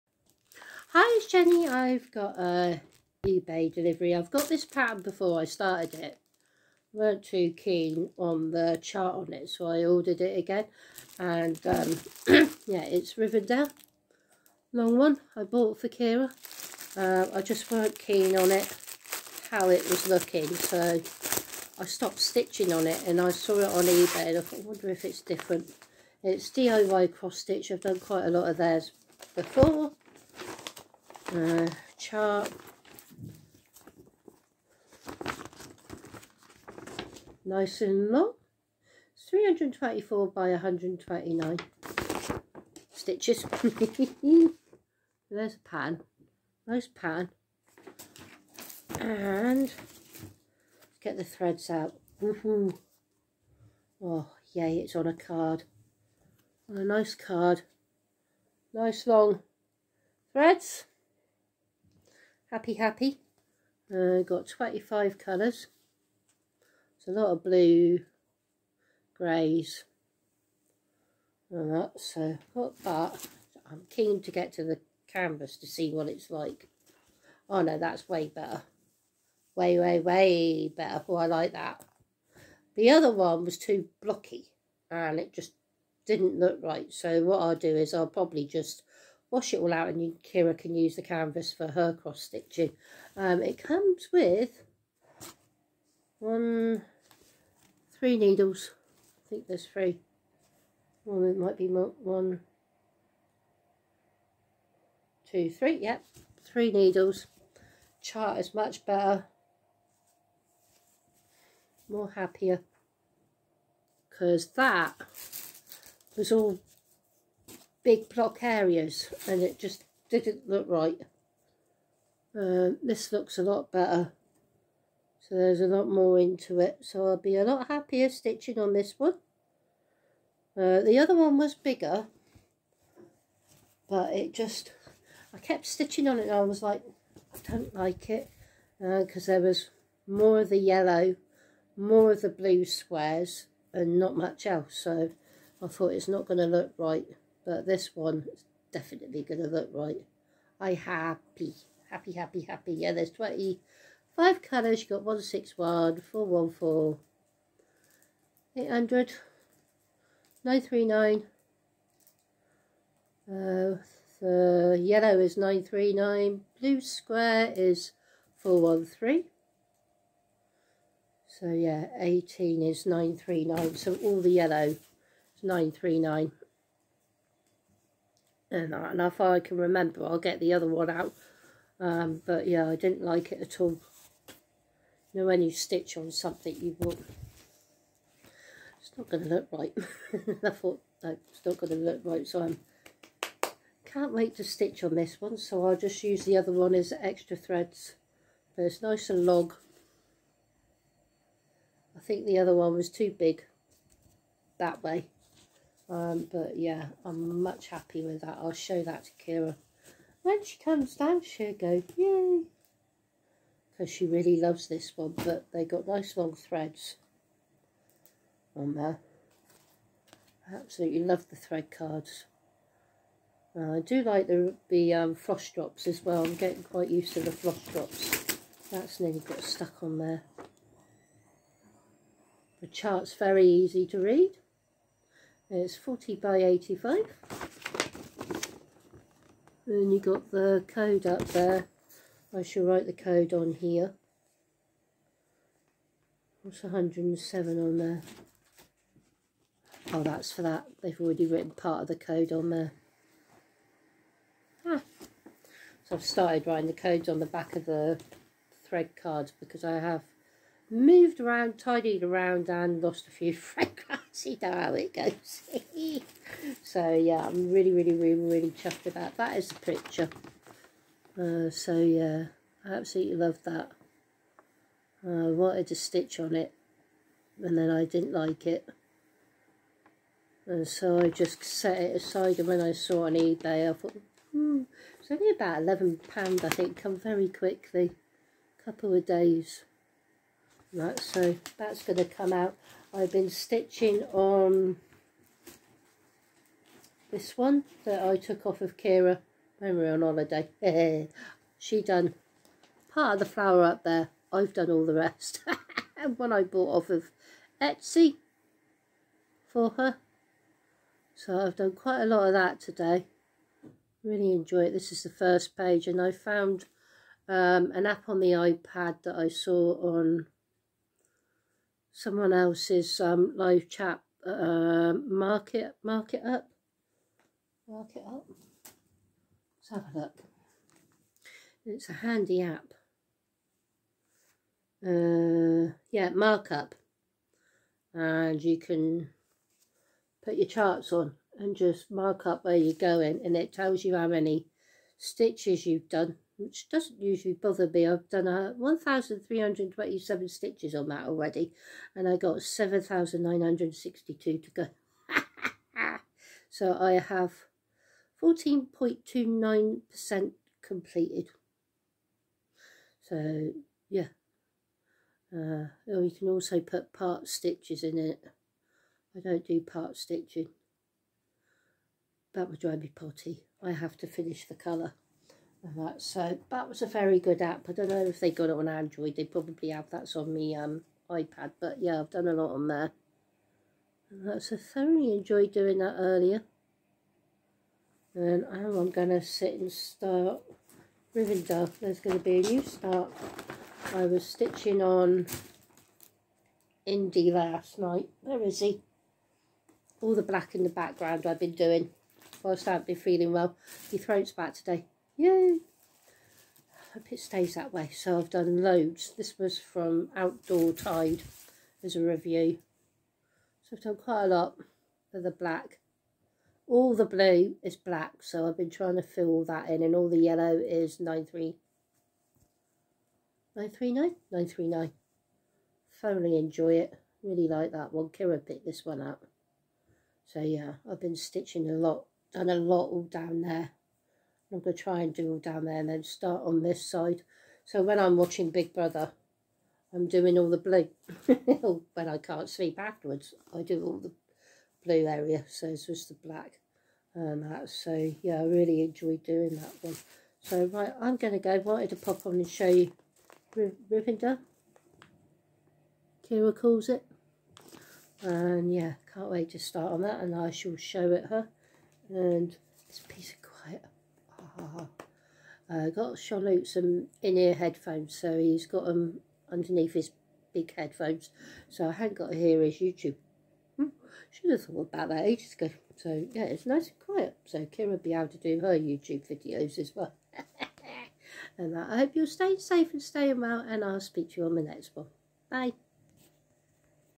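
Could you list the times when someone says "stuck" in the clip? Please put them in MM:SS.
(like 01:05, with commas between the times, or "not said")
03:49.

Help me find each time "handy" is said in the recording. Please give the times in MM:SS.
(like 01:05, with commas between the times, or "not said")
05:31.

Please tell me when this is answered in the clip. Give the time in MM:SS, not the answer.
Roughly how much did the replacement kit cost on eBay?
04:45.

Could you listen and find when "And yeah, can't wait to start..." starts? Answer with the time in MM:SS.
07:38.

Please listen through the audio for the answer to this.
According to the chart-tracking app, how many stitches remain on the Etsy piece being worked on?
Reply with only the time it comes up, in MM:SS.
05:52.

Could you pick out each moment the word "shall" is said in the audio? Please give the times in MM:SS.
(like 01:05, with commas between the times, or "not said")
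04:02, 07:40.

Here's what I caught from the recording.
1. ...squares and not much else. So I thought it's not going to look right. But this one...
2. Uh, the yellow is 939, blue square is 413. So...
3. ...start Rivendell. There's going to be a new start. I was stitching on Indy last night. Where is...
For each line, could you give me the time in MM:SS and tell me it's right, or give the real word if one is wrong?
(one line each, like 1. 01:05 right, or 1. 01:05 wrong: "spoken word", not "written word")
1. 02:22 right
2. 02:43 right
3. 06:29 right.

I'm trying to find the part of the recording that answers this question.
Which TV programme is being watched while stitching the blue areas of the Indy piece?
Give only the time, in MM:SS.
07:18.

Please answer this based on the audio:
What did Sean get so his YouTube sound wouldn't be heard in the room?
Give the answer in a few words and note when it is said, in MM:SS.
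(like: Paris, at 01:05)
In-ear headphones, at 07:47.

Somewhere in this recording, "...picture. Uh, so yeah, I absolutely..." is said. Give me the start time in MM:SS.
04:29.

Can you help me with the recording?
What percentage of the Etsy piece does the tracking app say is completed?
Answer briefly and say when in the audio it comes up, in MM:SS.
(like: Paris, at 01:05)
14.29%, at 05:58.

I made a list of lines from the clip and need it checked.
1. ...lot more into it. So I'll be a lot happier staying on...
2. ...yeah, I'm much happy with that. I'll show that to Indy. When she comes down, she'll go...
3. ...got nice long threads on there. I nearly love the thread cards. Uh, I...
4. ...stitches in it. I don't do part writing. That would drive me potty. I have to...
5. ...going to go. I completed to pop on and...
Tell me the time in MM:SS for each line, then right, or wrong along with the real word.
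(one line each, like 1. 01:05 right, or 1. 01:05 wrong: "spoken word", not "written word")
1. 02:05 wrong: "stitching", not "staying"
2. 03:26 wrong: "Kira", not "Indy"
3. 03:35 wrong: "absolutely", not "nearly"
4. 06:07 wrong: "stitching", not "writing"
5. 07:31 wrong: "wanted", not "completed".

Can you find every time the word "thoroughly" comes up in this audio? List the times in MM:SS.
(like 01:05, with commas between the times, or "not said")
06:24, 07:06.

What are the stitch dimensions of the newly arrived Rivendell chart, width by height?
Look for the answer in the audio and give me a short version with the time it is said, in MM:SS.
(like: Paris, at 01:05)
324 by 129, at 00:39.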